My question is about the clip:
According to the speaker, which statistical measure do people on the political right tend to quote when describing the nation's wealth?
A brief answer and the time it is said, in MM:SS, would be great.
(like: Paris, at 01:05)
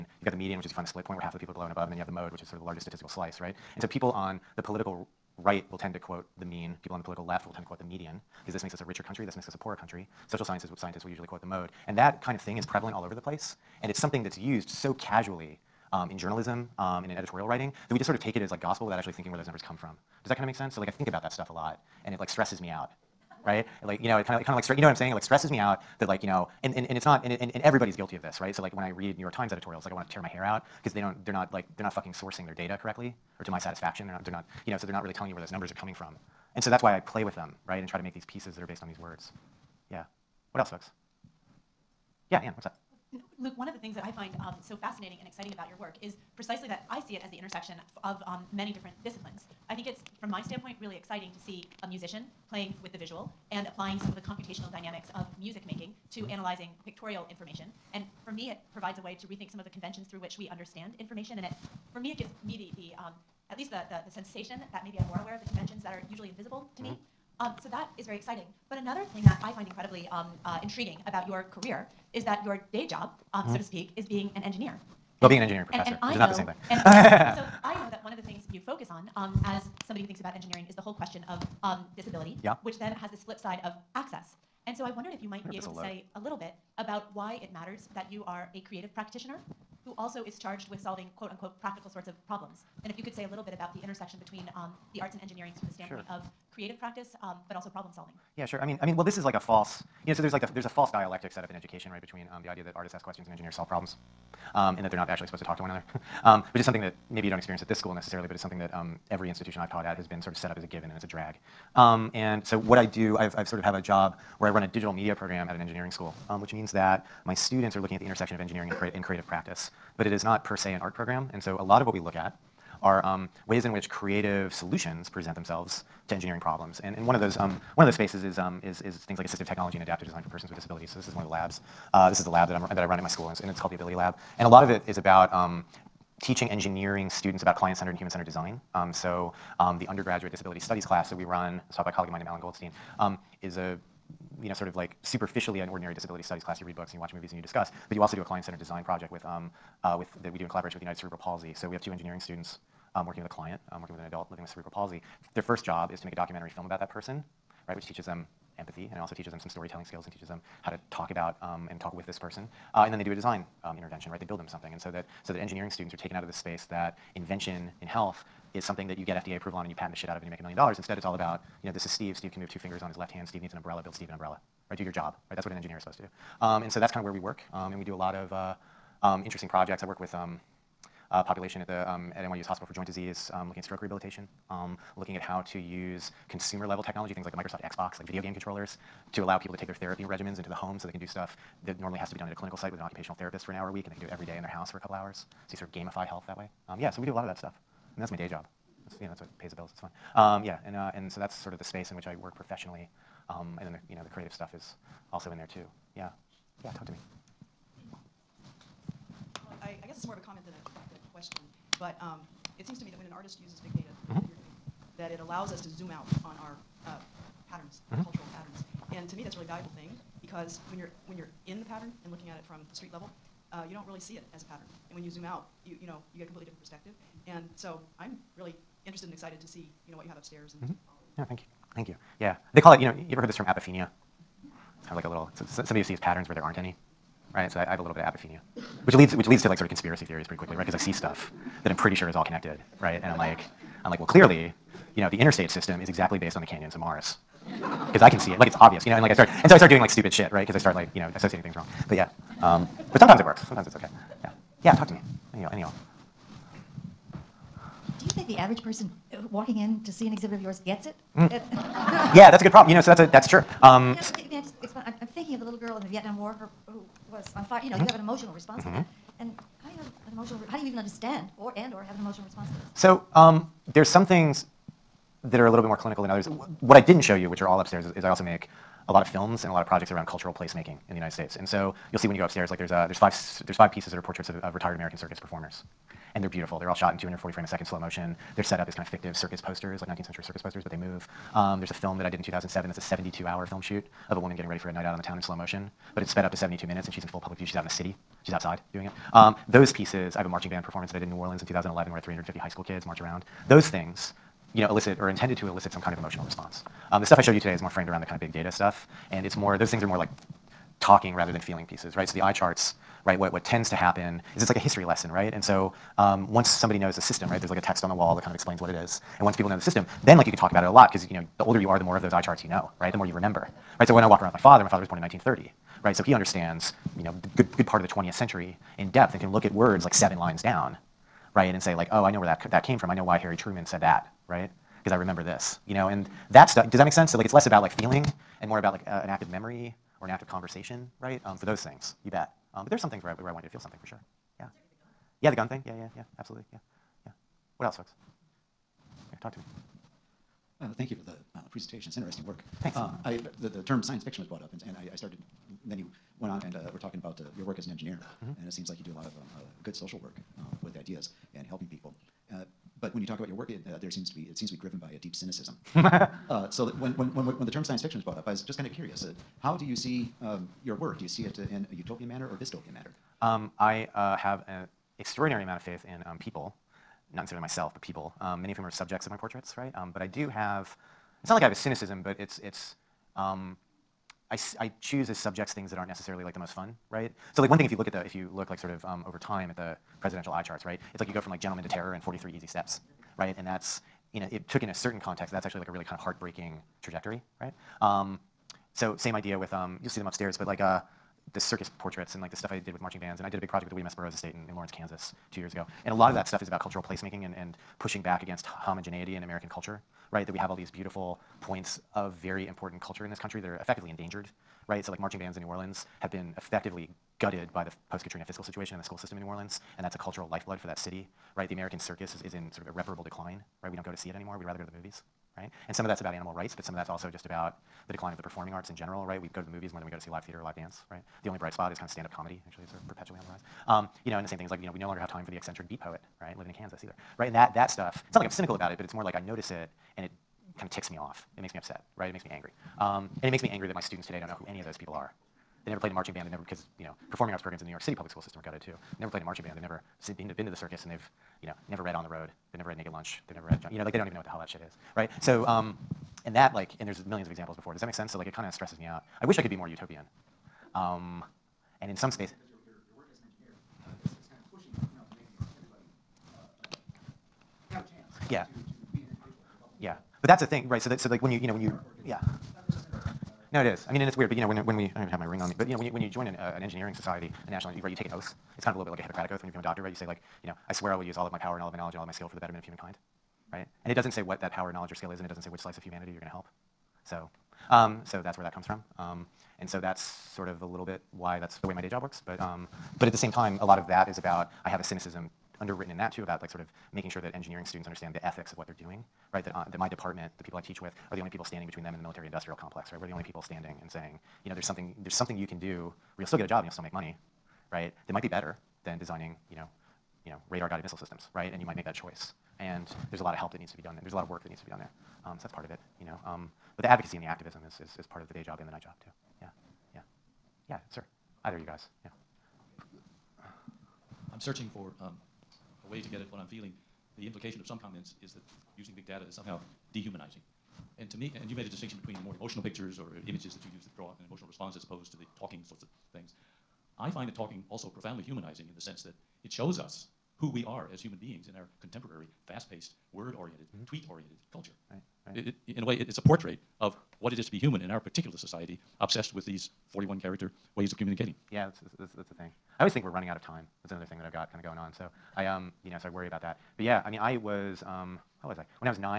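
The mean, at 00:06.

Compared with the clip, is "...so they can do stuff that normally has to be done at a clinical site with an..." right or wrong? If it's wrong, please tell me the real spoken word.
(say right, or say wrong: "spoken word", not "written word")
right.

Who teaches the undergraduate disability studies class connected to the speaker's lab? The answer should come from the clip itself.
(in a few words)
Alan Goldstein.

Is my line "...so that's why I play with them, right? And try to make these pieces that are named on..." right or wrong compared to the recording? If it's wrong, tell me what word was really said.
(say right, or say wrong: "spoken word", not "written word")
wrong: "based", not "named".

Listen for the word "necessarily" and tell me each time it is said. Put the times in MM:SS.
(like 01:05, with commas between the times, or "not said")
01:47, 06:17, 06:25.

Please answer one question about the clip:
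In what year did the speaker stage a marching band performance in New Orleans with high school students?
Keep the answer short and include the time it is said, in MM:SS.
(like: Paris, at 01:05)
2011, at 05:01.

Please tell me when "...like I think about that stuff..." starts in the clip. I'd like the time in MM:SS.
00:20.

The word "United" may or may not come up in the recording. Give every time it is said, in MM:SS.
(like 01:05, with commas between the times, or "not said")
02:30, 04:40.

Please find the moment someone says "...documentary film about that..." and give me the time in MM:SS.
02:36.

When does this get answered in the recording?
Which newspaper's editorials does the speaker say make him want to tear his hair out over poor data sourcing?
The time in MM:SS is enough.
00:29.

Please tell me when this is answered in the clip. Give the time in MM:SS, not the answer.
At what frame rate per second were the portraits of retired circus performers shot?
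04:46.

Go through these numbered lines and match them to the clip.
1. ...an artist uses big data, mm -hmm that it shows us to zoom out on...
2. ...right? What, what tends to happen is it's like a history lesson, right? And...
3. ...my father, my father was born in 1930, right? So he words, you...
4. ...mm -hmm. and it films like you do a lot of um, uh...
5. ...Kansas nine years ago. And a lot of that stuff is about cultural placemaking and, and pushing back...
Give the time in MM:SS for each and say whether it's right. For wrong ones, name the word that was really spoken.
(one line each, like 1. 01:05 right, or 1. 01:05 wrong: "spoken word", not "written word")
1. 03:33 wrong: "allows", not "shows"
2. 05:13 right
3. 05:24 wrong: "understands", not "words"
4. 05:58 wrong: "seems", not "films"
5. 06:44 wrong: "two", not "nine".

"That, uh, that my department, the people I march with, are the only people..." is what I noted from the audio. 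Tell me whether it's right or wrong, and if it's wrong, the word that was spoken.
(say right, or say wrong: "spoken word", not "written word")
wrong: "teach", not "march".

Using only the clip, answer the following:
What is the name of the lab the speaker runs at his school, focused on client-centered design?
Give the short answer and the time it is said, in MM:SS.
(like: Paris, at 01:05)
Ability Lab, at 02:13.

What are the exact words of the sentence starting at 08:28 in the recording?
That might be better than designing, you know, you know, radar-guided missile systems, right?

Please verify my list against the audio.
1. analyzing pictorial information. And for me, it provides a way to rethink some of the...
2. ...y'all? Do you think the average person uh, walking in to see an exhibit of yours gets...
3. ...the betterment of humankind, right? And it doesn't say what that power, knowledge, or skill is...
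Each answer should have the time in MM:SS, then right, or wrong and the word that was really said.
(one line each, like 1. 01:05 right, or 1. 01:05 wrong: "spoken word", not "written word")
1. 00:56 right
2. 04:15 right
3. 08:02 right.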